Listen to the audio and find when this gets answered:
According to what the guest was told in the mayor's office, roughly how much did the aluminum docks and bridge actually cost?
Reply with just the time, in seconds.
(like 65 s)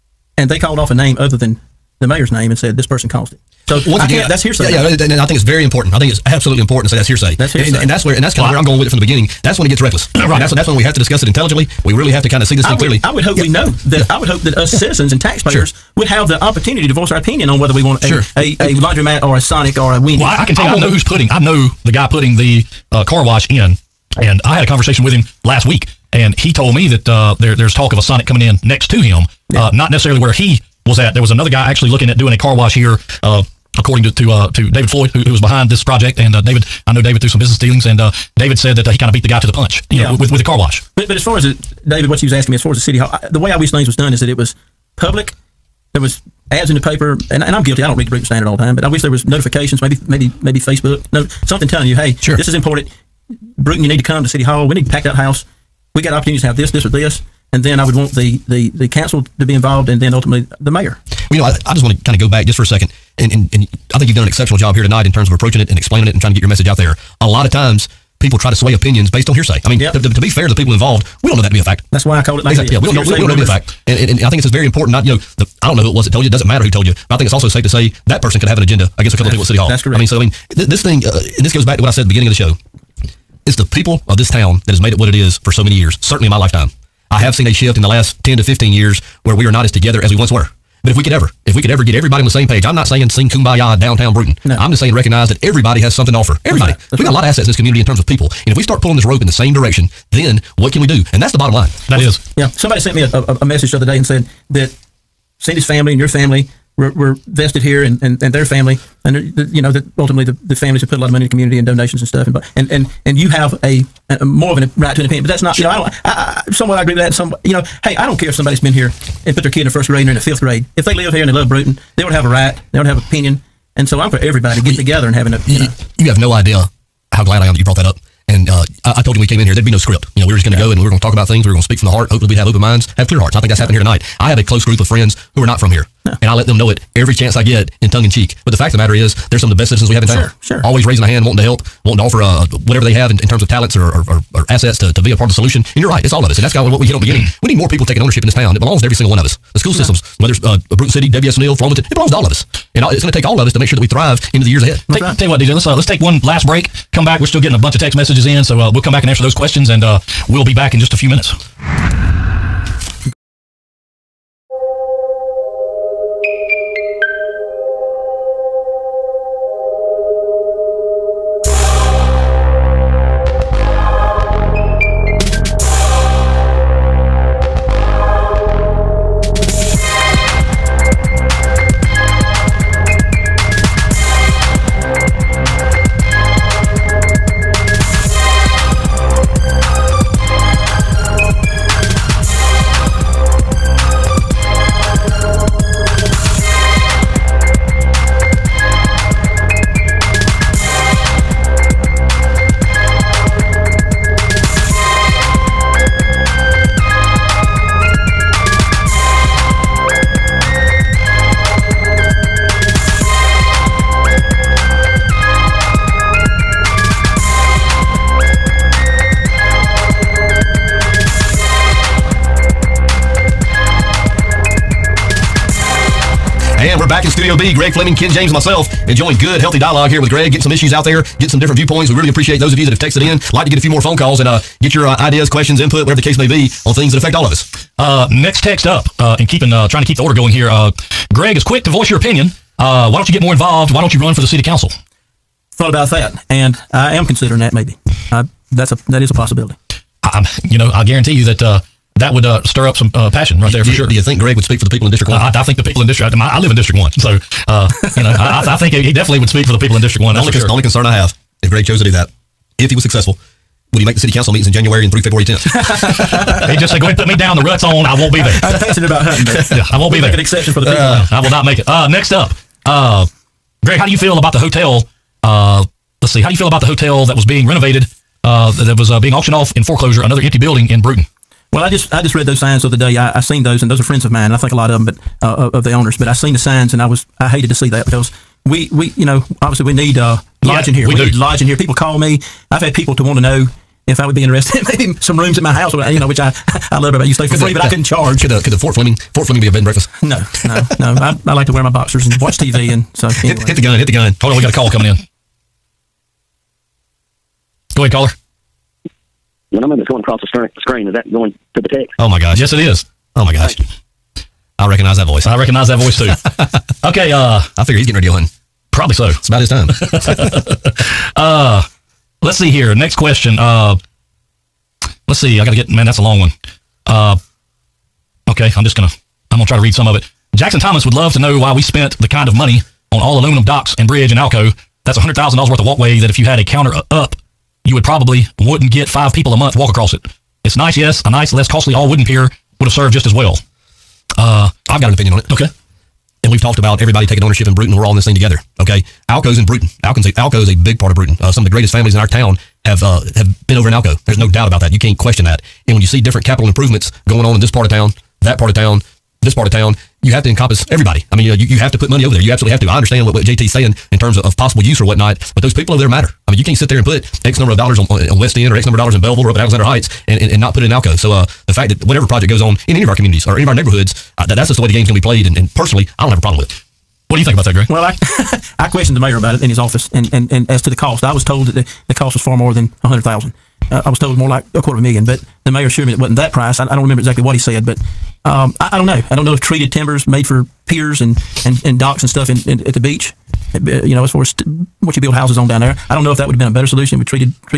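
384 s.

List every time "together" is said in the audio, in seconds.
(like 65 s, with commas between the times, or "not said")
89 s, 124 s, 348 s.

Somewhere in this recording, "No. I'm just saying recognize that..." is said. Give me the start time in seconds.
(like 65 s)
94 s.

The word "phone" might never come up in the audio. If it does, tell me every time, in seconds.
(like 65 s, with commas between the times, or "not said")
233 s.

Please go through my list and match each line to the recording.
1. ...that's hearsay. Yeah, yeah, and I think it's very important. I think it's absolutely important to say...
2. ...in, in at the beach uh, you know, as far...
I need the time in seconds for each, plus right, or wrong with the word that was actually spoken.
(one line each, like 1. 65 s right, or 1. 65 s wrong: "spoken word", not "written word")
1. 4 s right
2. 392 s right.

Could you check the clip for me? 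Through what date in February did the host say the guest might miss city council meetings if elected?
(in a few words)
February 10th.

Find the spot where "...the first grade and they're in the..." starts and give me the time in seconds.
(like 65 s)
119 s.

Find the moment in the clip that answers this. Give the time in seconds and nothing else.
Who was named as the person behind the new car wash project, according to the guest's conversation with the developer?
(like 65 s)
34 s.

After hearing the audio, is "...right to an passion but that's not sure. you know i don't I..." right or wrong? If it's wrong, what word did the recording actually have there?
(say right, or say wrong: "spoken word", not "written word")
wrong: "opinion", not "passion".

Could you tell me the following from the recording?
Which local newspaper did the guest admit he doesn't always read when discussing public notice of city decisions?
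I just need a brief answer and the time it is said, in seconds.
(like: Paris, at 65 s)
Brewton Standard, at 48 s.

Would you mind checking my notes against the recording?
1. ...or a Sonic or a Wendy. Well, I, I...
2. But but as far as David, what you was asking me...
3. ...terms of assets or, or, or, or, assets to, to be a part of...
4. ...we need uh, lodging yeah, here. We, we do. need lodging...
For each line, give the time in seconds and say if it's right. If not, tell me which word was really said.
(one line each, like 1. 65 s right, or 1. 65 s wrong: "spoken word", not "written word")
1. 19 s right
2. 40 s right
3. 143 s wrong: "talents", not "assets"
4. 289 s right.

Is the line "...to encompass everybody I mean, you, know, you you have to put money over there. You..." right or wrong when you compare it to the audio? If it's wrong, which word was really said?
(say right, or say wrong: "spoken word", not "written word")
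right.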